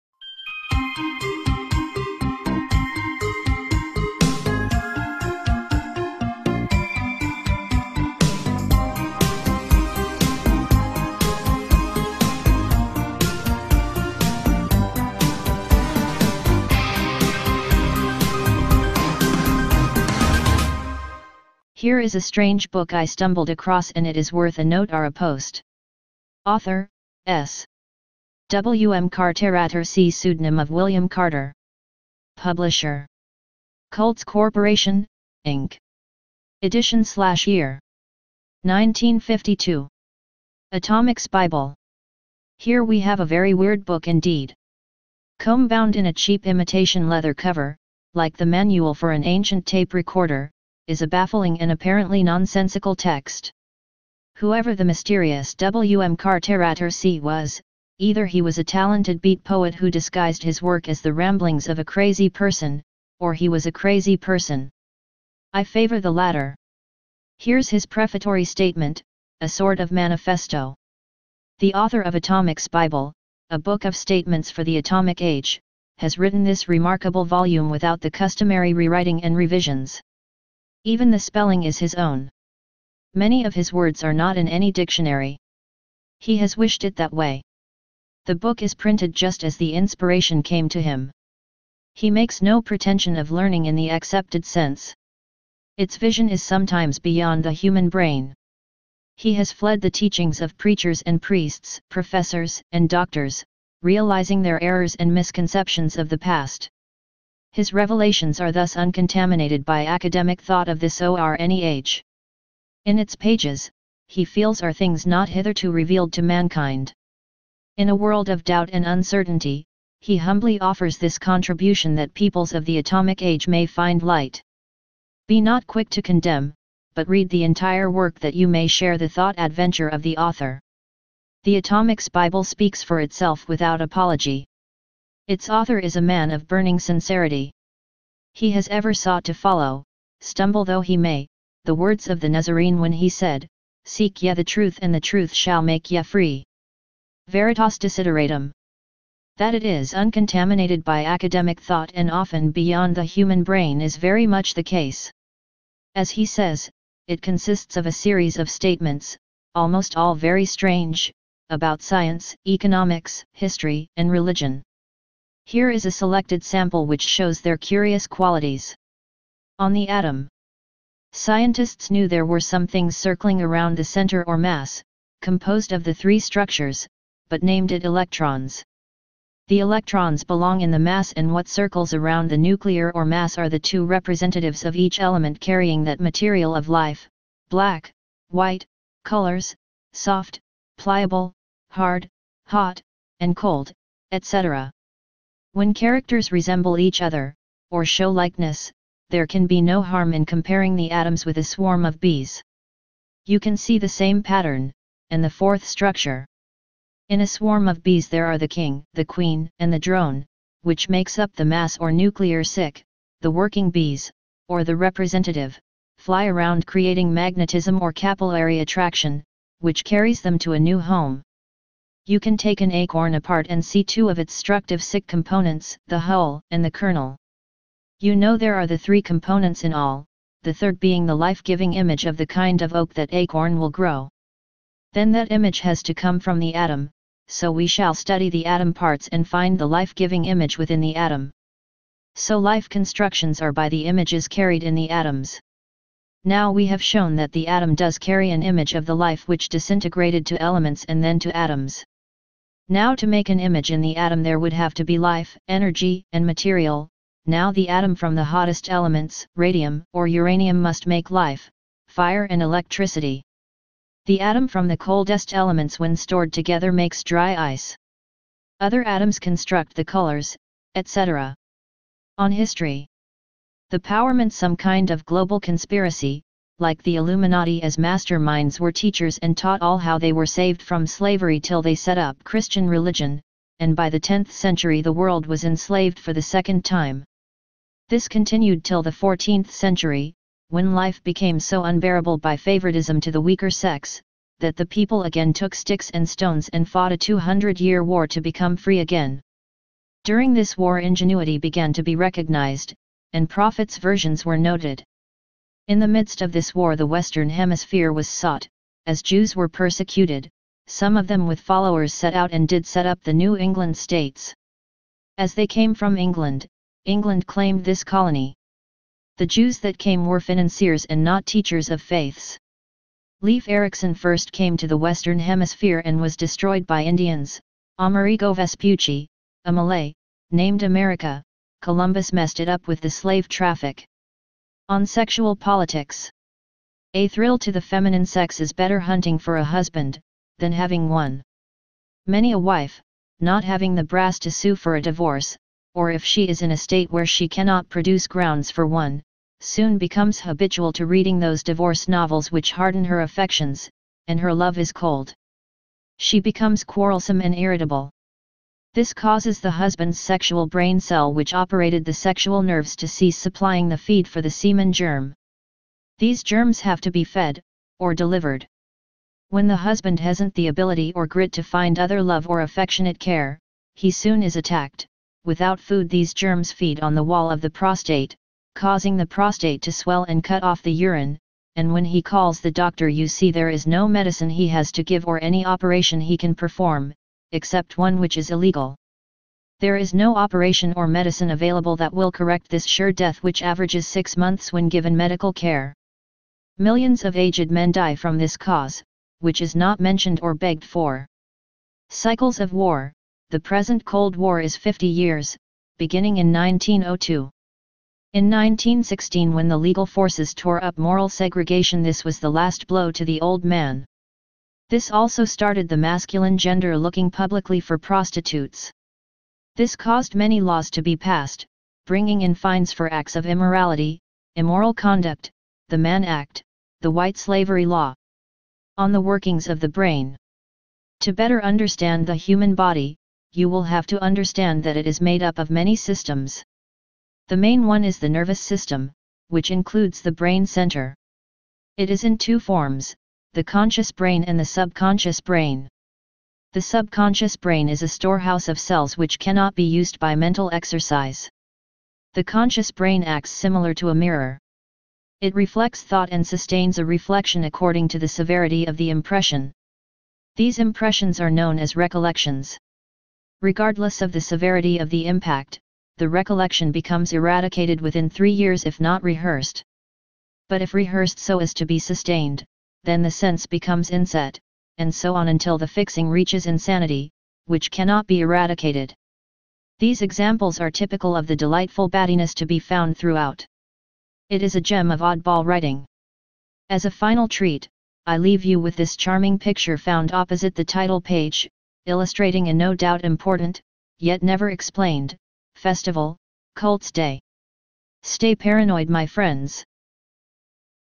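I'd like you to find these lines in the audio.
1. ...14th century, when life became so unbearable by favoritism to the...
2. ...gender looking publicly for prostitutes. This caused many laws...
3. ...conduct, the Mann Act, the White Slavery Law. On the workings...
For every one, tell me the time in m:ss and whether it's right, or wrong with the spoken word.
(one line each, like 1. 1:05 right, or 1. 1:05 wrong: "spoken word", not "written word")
1. 4:48 right
2. 6:56 right
3. 7:04 right.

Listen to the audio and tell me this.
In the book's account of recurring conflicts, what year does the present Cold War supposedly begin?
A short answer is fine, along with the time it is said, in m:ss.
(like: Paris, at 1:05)
1902, at 6:46.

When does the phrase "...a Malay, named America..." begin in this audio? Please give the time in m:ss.
5:29.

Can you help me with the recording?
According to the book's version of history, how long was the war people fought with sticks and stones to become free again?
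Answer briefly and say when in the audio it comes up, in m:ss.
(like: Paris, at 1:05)
200 years, at 4:56.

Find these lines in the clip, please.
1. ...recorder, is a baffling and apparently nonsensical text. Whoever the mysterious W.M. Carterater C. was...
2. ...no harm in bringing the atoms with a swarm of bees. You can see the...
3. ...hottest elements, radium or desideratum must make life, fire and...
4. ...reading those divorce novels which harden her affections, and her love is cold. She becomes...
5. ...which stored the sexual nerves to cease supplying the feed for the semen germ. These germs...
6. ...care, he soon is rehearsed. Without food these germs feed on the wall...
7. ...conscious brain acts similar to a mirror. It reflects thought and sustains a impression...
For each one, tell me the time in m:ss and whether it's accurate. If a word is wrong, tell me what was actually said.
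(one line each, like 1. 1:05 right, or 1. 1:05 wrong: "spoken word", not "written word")
1. 0:49 right
2. 3:19 wrong: "comparing", not "bringing"
3. 4:18 wrong: "uranium", not "desideratum"
4. 5:50 right
5. 6:01 wrong: "operated", not "stored"
6. 6:12 wrong: "attacked", not "rehearsed"
7. 7:32 wrong: "reflection", not "impression".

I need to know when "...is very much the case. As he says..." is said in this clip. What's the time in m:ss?
2:33.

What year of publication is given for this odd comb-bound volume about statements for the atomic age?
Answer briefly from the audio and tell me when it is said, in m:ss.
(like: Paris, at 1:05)
1952, at 0:38.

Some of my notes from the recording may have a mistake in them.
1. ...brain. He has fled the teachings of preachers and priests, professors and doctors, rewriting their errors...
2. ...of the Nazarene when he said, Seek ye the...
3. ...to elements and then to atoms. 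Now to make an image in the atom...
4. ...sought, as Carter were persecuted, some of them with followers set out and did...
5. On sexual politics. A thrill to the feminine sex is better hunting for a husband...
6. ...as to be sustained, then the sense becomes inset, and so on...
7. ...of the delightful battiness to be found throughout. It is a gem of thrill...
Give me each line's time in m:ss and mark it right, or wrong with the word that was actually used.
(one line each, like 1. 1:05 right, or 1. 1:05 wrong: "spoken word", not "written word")
1. 1:37 wrong: "realizing", not "rewriting"
2. 2:22 right
3. 4:10 right
4. 5:08 wrong: "Jews", not "Carter"
5. 5:34 right
6. 7:51 right
7. 8:01 wrong: "oddball", not "thrill".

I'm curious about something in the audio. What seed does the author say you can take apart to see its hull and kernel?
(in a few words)
an acorn.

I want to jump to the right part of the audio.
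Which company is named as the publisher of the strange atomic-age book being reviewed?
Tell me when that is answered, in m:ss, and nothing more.
0:33.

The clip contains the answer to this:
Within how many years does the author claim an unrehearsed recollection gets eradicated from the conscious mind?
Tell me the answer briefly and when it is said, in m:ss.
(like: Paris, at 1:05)
3, at 7:48.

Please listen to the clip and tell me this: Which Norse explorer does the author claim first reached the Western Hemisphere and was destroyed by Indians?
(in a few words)
Leif Erikson.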